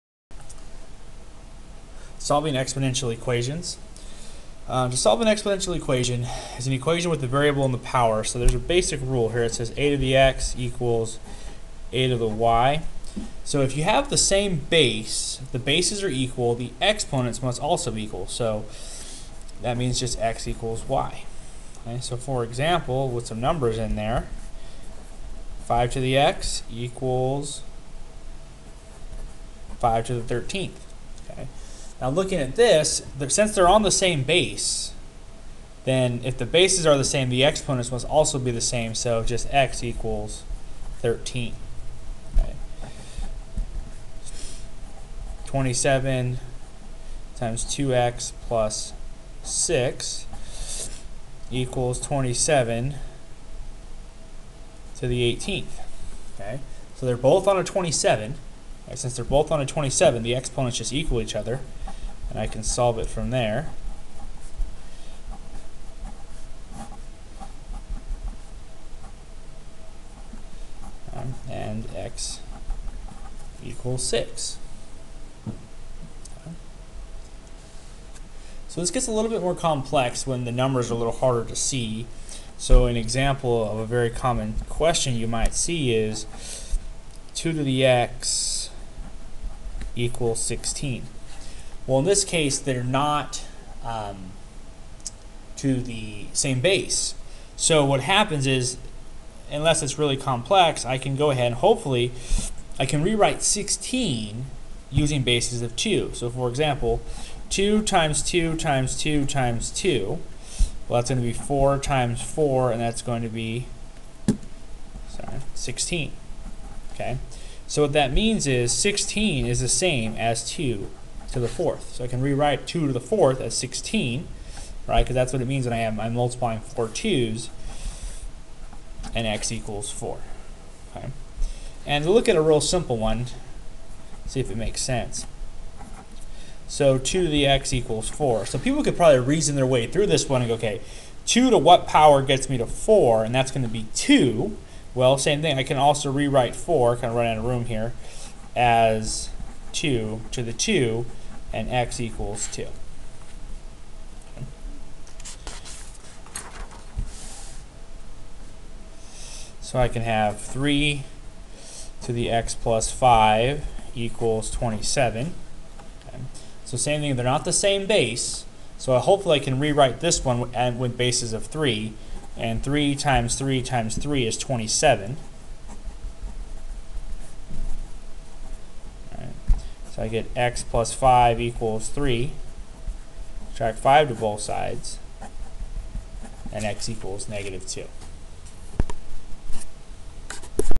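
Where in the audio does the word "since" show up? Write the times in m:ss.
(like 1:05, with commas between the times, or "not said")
0:33, 0:58.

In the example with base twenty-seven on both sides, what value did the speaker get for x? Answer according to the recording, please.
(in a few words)
6.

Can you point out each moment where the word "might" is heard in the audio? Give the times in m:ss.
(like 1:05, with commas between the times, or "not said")
1:25.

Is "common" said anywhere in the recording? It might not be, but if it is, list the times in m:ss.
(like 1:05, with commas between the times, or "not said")
1:24.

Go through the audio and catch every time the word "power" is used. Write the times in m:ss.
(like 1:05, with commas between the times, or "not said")
0:07, 2:21.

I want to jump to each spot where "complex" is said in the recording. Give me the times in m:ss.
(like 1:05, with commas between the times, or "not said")
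1:19, 1:40.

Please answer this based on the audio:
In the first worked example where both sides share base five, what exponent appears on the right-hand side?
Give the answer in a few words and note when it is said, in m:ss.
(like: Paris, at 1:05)
13, at 0:29.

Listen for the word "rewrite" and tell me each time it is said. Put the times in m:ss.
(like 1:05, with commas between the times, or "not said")
1:43, 2:02, 2:26, 2:49.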